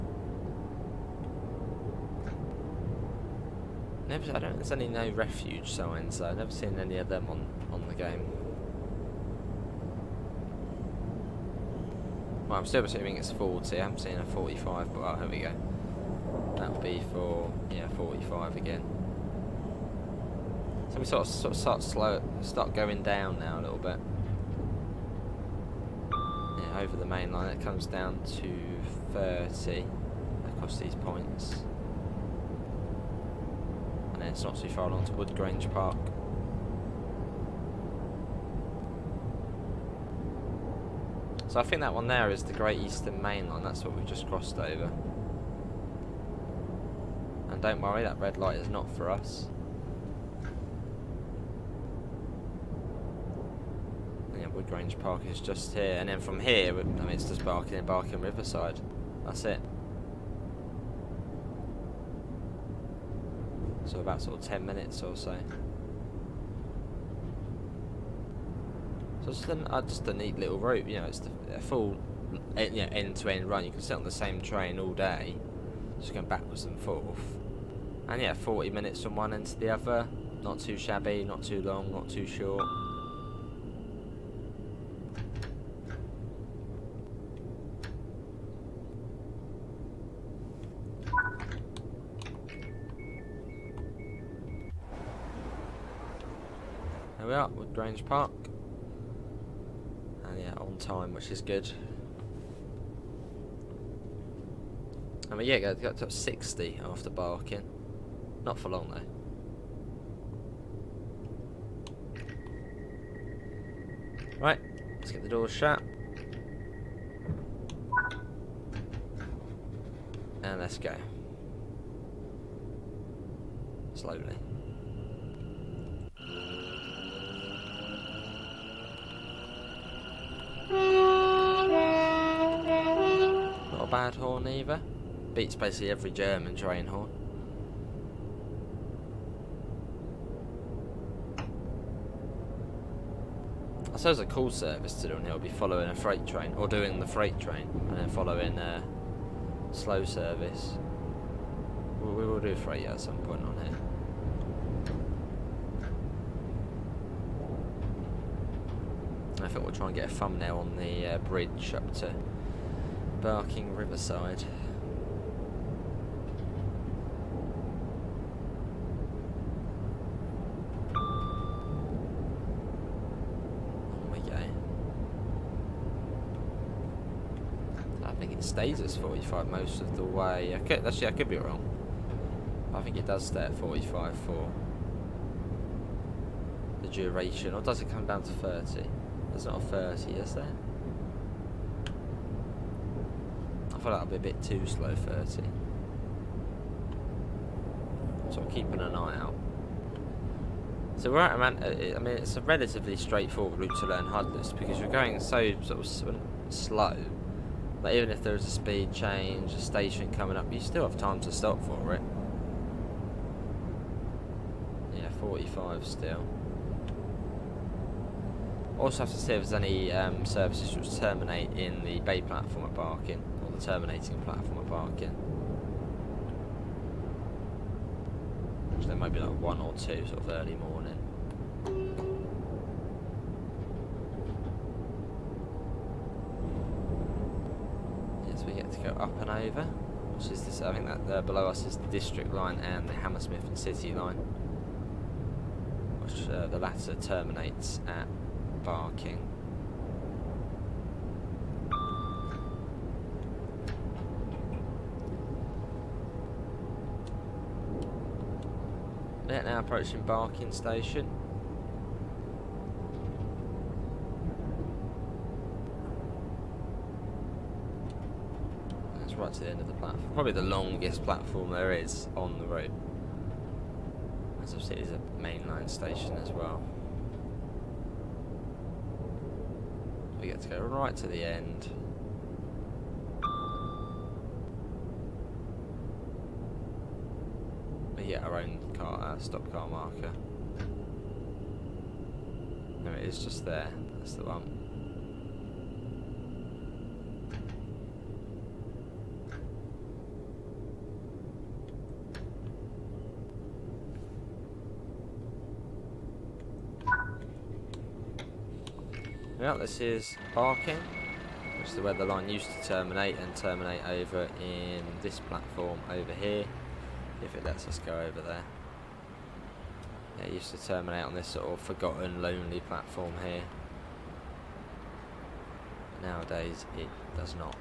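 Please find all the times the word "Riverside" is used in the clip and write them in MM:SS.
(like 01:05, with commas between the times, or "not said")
00:58, 02:43.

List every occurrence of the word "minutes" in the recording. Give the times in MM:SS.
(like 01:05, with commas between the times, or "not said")
01:04, 01:18.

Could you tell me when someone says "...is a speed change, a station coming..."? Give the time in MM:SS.
03:28.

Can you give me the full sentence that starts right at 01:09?
So it's just a, uh, just a neat little route, you know, it's the, a full you know, end to end run.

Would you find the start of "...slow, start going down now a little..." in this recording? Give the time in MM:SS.
00:21.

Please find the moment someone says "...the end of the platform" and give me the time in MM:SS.
04:29.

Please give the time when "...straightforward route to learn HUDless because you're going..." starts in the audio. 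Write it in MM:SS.
03:22.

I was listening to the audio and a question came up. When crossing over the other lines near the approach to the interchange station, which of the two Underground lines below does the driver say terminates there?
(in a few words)
Hammersmith and City line.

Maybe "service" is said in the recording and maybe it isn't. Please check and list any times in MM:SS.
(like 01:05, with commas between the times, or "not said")
02:24, 02:30, 03:40.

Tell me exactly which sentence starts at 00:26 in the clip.
Yeah, over the main line, it comes down to 30 across these points it's not too far along to Woodgrange Park.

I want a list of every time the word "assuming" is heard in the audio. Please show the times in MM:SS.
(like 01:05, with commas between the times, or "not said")
00:12.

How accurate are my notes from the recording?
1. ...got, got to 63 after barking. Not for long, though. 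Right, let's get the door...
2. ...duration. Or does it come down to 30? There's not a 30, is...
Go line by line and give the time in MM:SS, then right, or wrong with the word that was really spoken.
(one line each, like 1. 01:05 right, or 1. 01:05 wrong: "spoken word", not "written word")
1. 01:45 wrong: "60", not "63"
2. 03:06 right.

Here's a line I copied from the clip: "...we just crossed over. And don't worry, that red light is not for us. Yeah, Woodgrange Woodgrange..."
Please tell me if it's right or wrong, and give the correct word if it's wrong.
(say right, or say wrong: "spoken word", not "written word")
wrong: "Park", not "Woodgrange".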